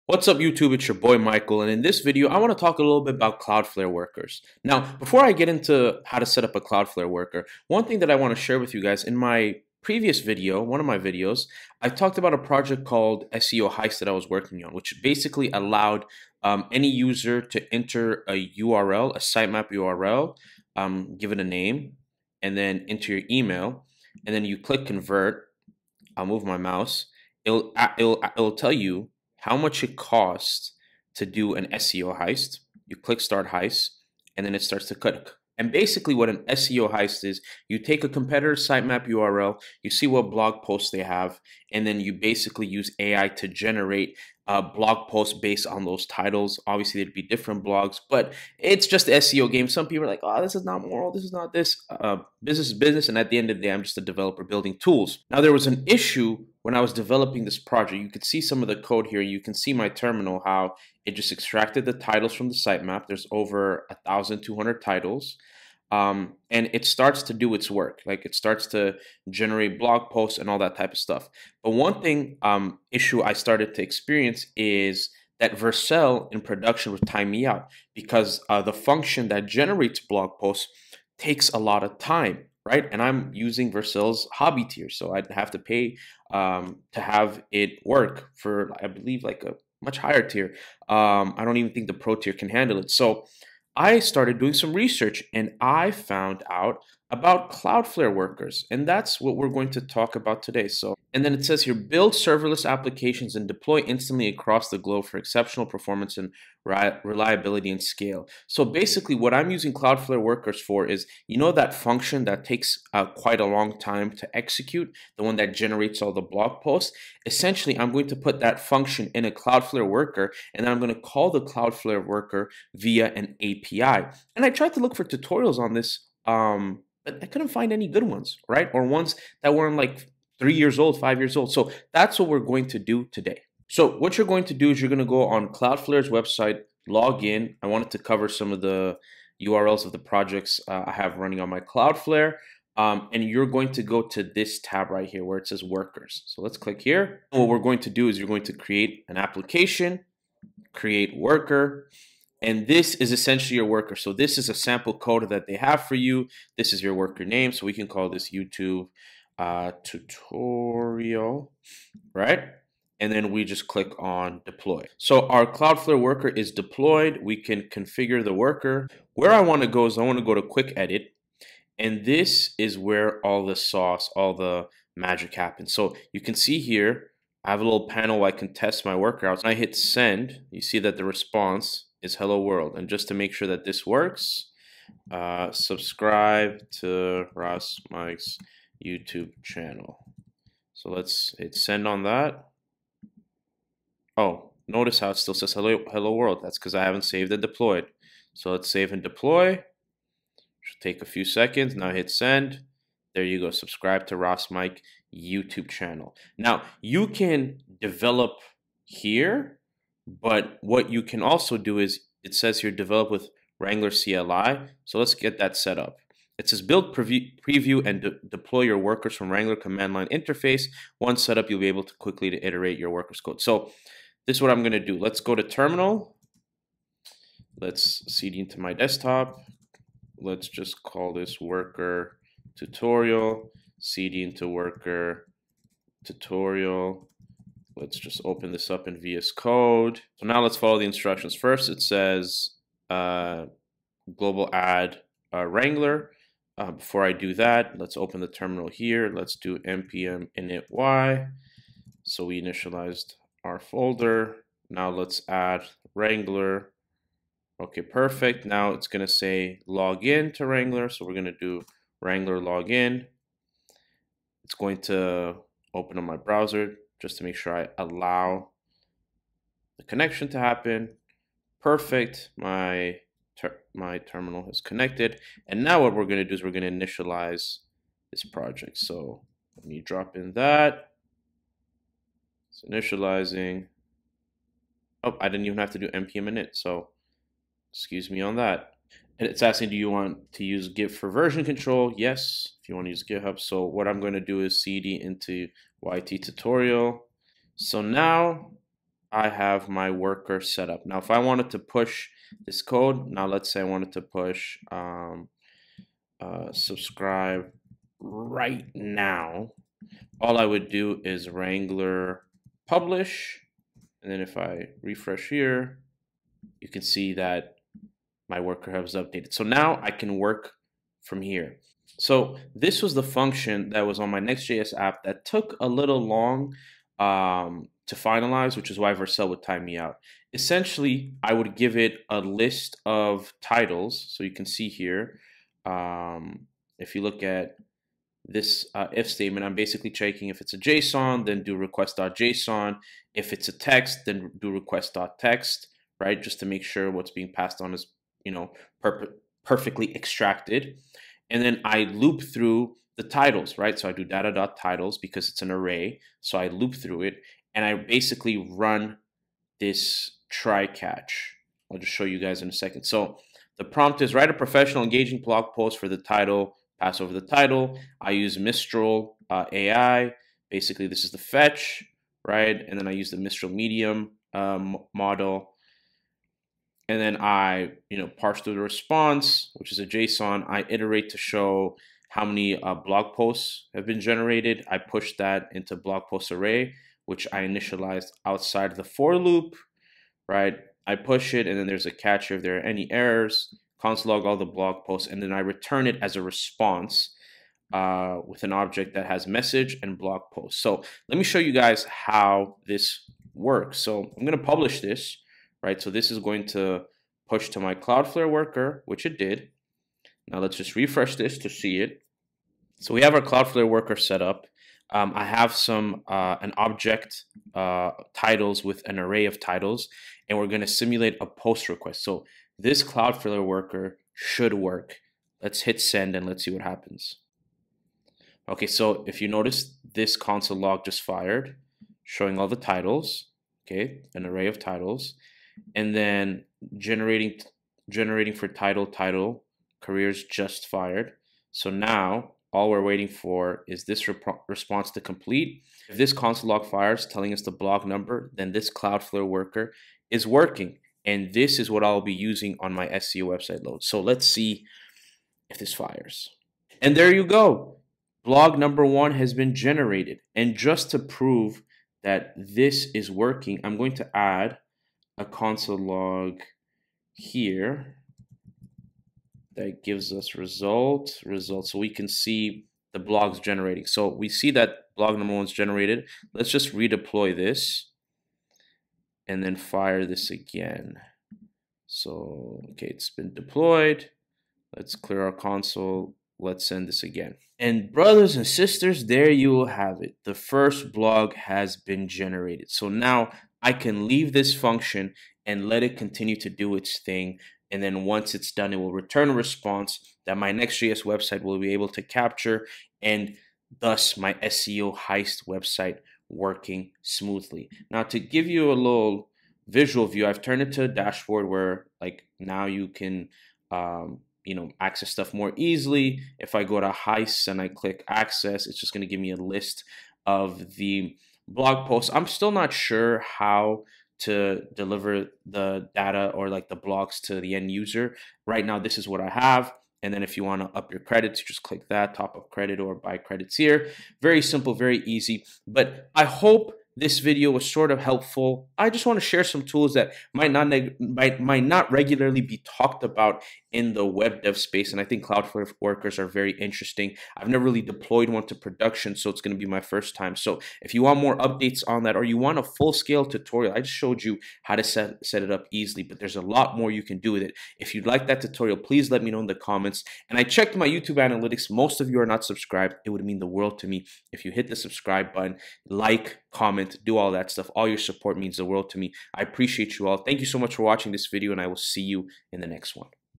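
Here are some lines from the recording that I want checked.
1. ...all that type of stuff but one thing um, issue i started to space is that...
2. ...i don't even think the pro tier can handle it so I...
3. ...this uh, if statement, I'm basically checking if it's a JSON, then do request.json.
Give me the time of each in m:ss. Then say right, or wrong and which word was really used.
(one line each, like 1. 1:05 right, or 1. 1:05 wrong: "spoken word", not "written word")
1. 1:10 wrong: "experience", not "space"
2. 1:31 right
3. 5:38 right.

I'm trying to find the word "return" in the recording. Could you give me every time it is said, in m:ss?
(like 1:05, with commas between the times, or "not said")
6:35, 8:18.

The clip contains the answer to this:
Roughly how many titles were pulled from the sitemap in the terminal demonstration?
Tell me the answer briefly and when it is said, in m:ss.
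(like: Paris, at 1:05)
1,200, at 1:04.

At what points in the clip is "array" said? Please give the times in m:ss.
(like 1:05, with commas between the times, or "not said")
5:55, 6:26, 6:58, 7:14.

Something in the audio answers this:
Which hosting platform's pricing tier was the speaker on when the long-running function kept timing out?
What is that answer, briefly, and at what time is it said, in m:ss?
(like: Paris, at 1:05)
Hobby tier, at 1:24.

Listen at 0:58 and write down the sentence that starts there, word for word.
You could see some of the code here.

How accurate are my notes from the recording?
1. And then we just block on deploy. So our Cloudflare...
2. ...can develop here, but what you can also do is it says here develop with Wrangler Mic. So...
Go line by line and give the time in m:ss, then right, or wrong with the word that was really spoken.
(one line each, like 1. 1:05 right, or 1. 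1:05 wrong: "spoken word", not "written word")
1. 2:42 wrong: "click", not "block"
2. 3:27 wrong: "CLI", not "Mic".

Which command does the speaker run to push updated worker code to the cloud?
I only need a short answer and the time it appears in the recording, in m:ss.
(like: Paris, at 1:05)
Wrangler publish, at 5:11.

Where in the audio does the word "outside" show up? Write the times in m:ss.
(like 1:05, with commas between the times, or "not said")
6:28.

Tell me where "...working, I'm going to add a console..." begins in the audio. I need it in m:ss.
7:43.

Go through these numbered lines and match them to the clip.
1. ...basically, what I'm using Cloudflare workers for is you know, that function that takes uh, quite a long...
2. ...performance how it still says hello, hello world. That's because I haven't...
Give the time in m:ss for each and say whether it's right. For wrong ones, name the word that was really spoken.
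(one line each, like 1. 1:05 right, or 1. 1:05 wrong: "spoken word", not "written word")
1. 1:48 right
2. 3:14 wrong: "notice", not "performance".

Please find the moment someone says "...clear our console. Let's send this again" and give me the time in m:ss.
8:04.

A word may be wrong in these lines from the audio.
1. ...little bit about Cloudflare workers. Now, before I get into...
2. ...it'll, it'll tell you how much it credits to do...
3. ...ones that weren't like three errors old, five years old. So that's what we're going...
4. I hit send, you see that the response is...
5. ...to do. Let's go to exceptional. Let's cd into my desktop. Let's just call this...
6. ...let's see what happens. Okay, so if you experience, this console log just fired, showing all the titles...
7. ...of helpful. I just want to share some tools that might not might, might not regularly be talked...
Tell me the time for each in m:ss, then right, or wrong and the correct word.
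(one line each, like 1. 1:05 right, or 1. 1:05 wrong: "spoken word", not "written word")
1. 0:02 right
2. 0:27 wrong: "costs", not "credits"
3. 2:08 wrong: "years", not "errors"
4. 2:59 right
5. 3:44 wrong: "terminal", not "exceptional"
6. 7:06 wrong: "notice", not "experience"
7. 8:57 right.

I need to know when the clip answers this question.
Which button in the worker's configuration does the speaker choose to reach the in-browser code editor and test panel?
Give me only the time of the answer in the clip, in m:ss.
2:50.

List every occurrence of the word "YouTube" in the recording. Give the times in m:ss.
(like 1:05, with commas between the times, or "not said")
0:00, 2:38, 3:08, 3:25, 9:20.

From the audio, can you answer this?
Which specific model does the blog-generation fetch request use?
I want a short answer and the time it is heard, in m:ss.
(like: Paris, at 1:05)
Mistral Medium, at 6:13.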